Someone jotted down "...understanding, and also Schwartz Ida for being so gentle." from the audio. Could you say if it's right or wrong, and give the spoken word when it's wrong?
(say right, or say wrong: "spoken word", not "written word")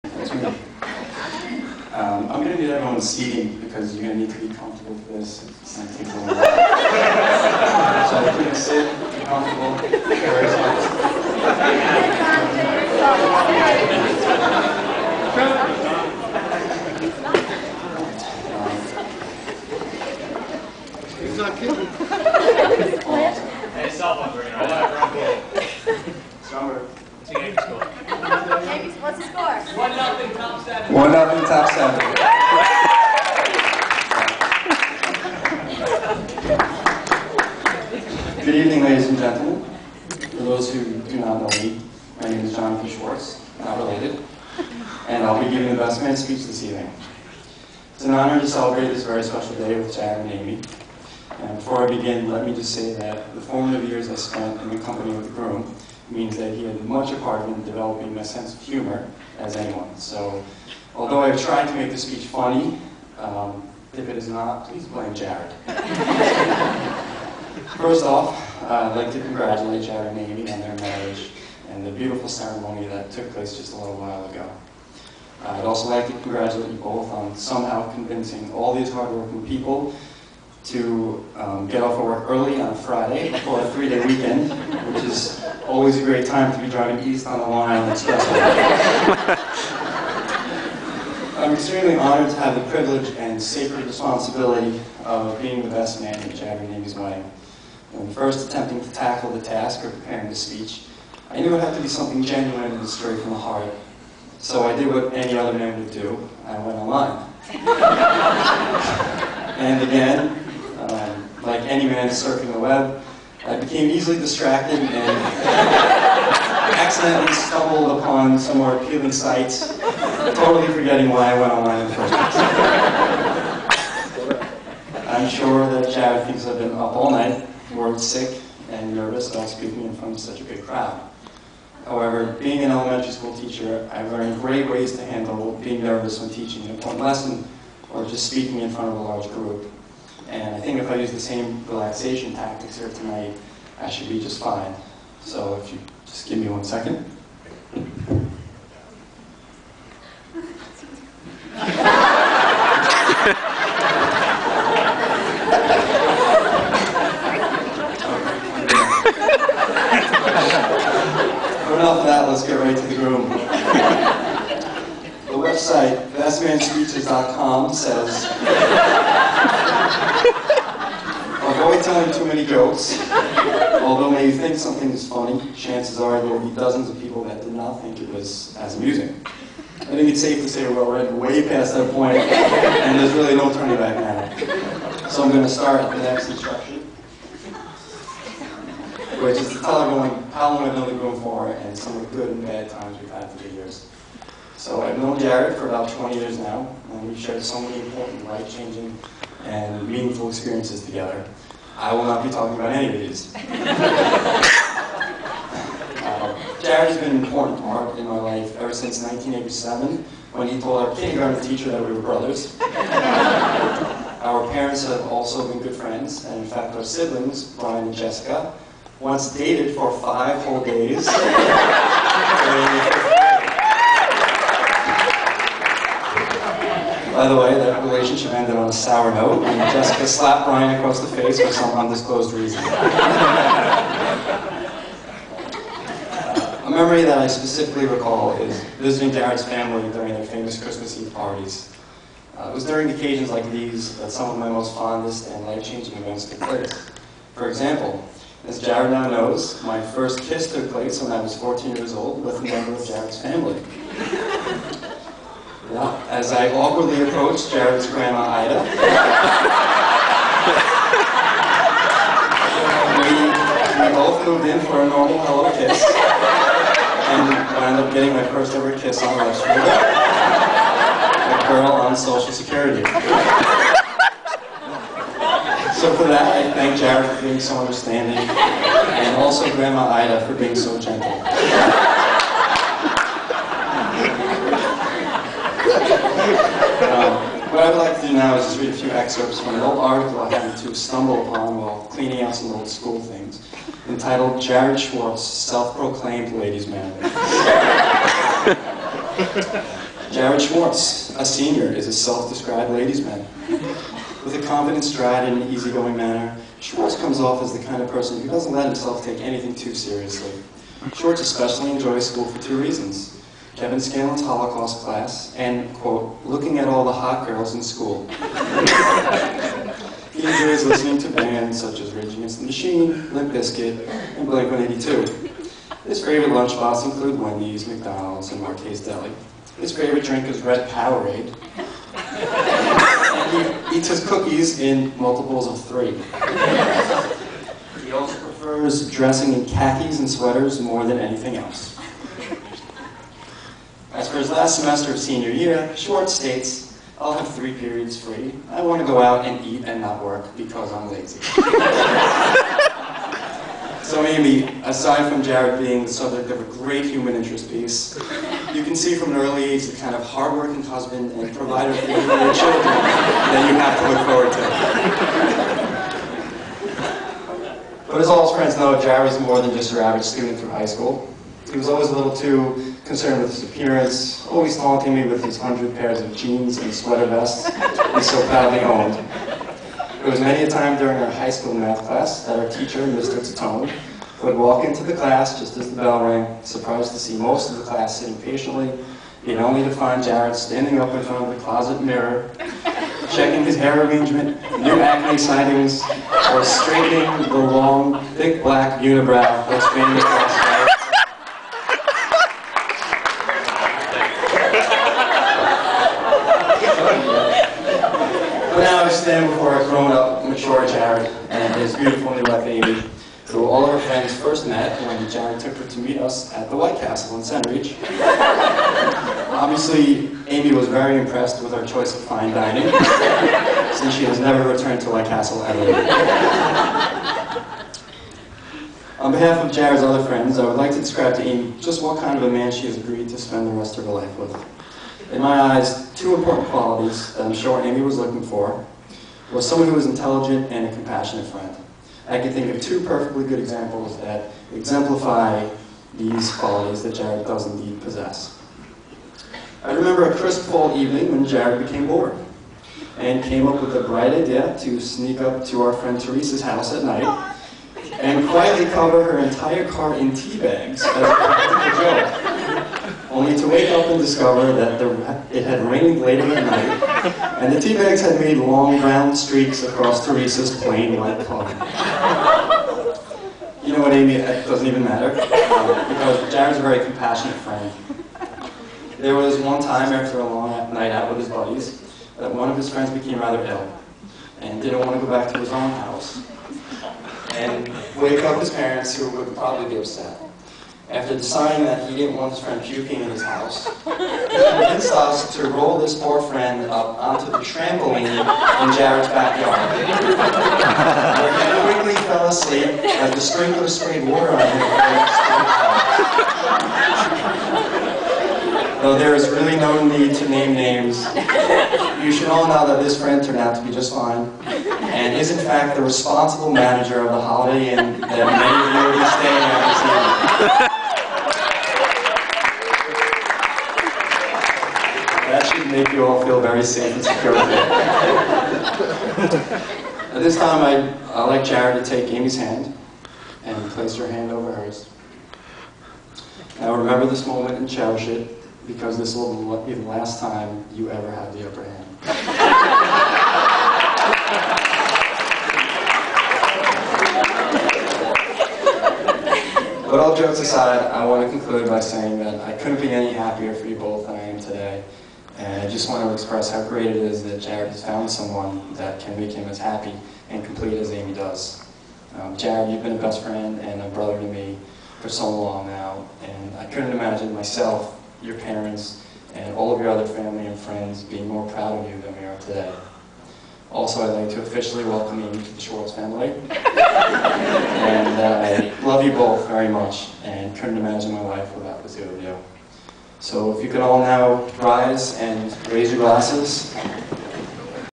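wrong: "Grandma", not "Schwartz".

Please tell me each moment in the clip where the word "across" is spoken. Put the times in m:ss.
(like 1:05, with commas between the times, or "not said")
3:50, 6:39, 7:49.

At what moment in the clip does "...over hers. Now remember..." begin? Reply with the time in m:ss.
8:54.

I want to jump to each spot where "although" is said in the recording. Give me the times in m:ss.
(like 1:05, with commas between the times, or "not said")
1:00, 2:53.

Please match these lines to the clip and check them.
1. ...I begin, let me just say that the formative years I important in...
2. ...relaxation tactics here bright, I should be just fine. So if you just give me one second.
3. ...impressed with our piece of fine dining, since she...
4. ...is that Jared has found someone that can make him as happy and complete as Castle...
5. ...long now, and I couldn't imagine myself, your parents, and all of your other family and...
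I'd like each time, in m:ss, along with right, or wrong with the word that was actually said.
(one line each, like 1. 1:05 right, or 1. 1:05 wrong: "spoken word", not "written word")
1. 0:51 wrong: "spent", not "important"
2. 2:21 wrong: "tonight", not "bright"
3. 7:00 wrong: "choice", not "piece"
4. 9:16 wrong: "Amy", not "Castle"
5. 9:25 right.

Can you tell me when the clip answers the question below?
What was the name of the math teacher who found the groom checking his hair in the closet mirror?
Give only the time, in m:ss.
6:22.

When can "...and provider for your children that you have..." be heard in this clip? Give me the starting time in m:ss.
6:01.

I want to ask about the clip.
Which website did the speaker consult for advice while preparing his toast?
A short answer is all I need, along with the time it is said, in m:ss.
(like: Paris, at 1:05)
bestmanspeeches.com, at 2:46.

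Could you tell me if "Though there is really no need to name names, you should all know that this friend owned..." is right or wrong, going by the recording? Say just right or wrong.
wrong.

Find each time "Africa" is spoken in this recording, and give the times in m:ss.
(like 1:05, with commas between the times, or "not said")
not said.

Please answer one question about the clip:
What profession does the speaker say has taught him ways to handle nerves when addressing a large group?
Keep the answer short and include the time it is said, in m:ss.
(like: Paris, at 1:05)
elementary school teacher, at 2:12.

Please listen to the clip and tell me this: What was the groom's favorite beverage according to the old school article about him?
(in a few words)
red Powerade.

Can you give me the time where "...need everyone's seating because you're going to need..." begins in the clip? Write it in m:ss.
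0:02.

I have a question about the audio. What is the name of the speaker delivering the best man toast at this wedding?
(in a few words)
Jonathan Schwartz.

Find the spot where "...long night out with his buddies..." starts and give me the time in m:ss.
8:00.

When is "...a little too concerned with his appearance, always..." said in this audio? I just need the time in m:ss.
6:11.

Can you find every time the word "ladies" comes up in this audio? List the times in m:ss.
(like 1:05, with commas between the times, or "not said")
0:38, 4:56, 5:02.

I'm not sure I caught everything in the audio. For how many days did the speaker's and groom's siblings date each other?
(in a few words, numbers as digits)
5.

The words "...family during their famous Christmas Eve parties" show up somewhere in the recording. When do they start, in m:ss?
3:59.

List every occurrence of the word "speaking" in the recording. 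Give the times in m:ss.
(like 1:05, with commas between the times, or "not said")
2:09, 2:18.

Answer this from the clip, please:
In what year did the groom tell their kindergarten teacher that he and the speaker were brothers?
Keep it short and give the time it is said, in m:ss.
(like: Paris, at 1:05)
1987, at 3:29.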